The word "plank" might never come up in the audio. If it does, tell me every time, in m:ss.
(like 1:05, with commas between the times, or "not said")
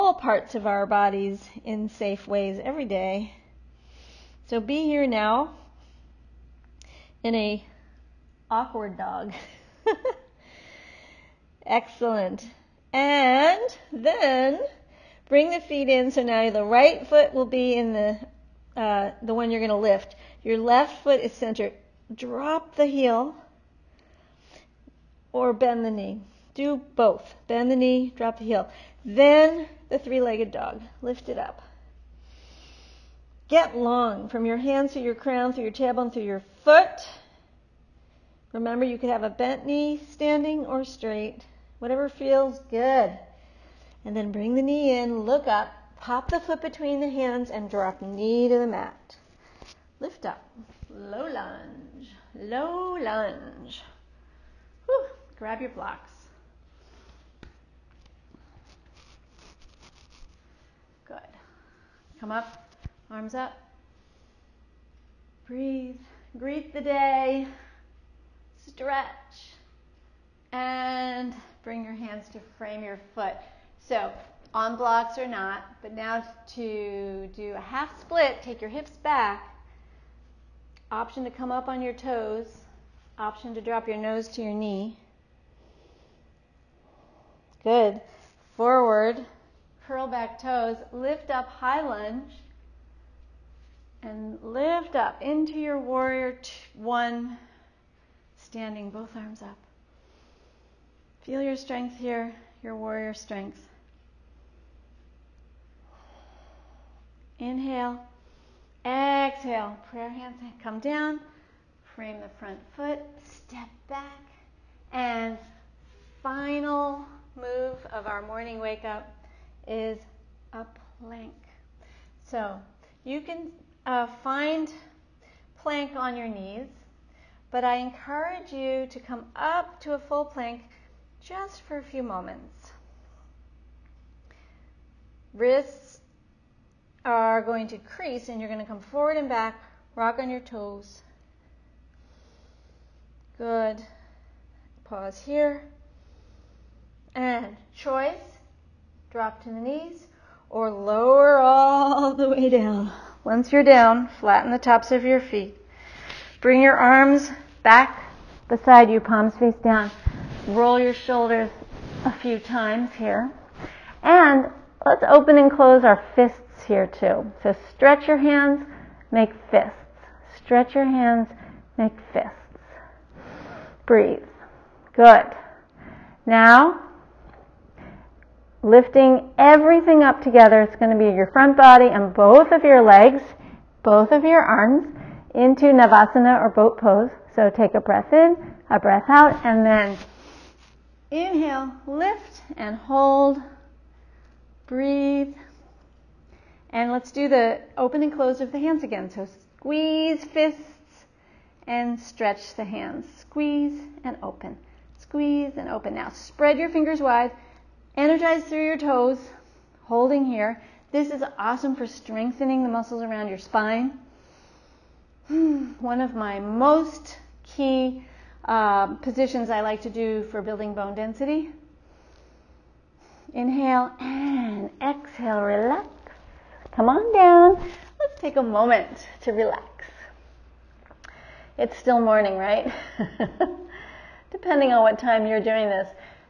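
2:00, 2:05, 2:10.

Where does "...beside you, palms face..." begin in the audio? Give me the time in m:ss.
2:38.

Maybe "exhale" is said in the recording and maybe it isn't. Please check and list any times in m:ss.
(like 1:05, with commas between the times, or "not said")
1:48, 3:44.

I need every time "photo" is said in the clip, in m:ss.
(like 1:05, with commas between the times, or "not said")
not said.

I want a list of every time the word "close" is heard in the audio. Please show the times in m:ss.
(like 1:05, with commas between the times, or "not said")
2:45, 3:18.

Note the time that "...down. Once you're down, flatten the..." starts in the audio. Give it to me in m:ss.
2:32.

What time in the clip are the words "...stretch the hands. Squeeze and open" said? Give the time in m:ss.
3:21.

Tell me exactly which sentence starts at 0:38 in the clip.
Remember, you could have a bent knee standing or straight, whatever feels good.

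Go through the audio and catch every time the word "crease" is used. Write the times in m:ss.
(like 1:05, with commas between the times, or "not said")
2:17.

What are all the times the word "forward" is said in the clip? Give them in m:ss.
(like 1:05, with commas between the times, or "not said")
1:28, 2:18.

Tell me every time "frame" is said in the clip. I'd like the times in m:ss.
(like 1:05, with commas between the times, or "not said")
1:12, 1:51.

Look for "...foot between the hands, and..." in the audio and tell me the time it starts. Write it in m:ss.
0:46.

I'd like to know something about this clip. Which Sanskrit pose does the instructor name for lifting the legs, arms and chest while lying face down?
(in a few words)
Navasana.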